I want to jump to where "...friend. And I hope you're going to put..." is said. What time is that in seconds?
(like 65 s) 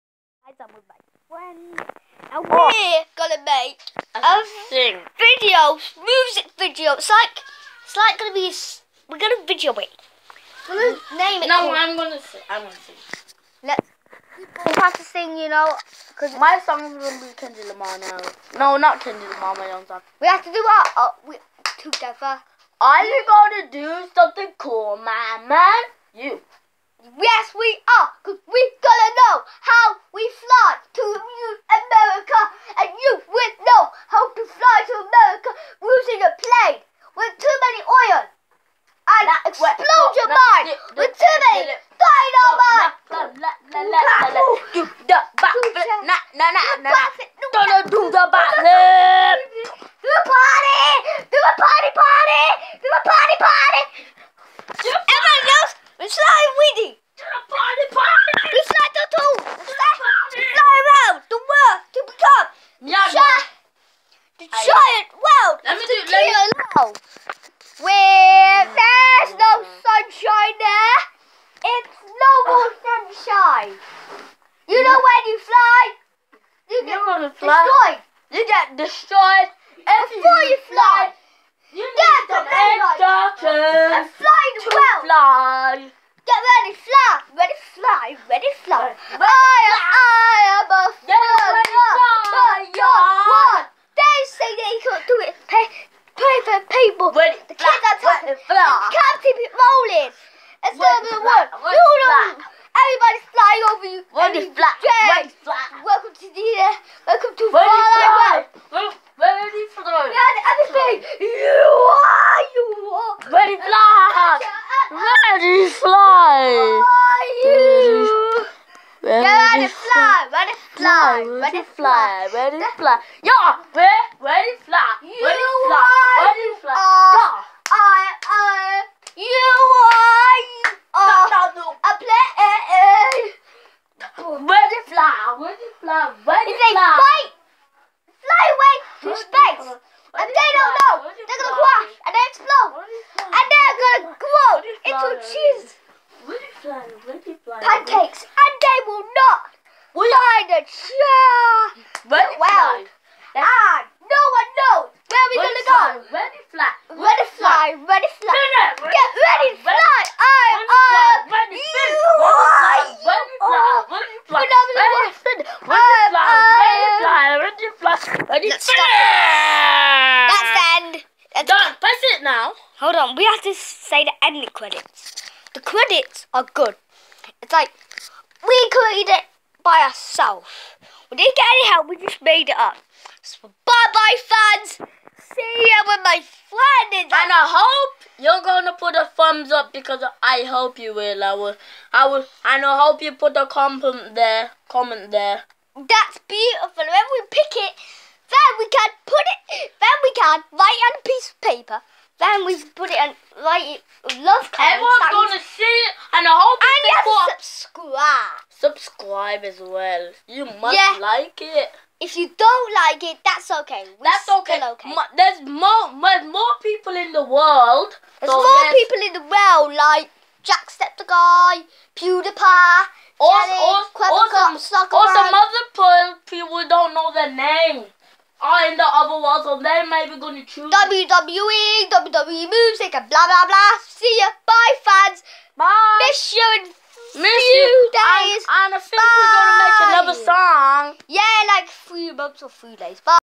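186 s.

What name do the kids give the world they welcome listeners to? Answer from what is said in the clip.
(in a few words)
Far Life World.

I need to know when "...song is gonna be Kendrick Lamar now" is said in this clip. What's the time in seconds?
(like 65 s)
16 s.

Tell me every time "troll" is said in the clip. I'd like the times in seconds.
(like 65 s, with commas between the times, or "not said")
not said.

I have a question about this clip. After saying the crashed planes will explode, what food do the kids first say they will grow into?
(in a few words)
cheese.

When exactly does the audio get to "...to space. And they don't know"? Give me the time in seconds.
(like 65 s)
139 s.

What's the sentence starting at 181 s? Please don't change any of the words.
We didn't get any help, we just made it up.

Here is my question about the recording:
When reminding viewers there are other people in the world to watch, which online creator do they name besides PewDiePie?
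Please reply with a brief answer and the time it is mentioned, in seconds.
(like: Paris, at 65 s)
Jacksepticeye, at 220 s.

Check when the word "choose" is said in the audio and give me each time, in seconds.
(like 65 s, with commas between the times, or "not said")
230 s.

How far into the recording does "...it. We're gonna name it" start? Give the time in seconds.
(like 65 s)
9 s.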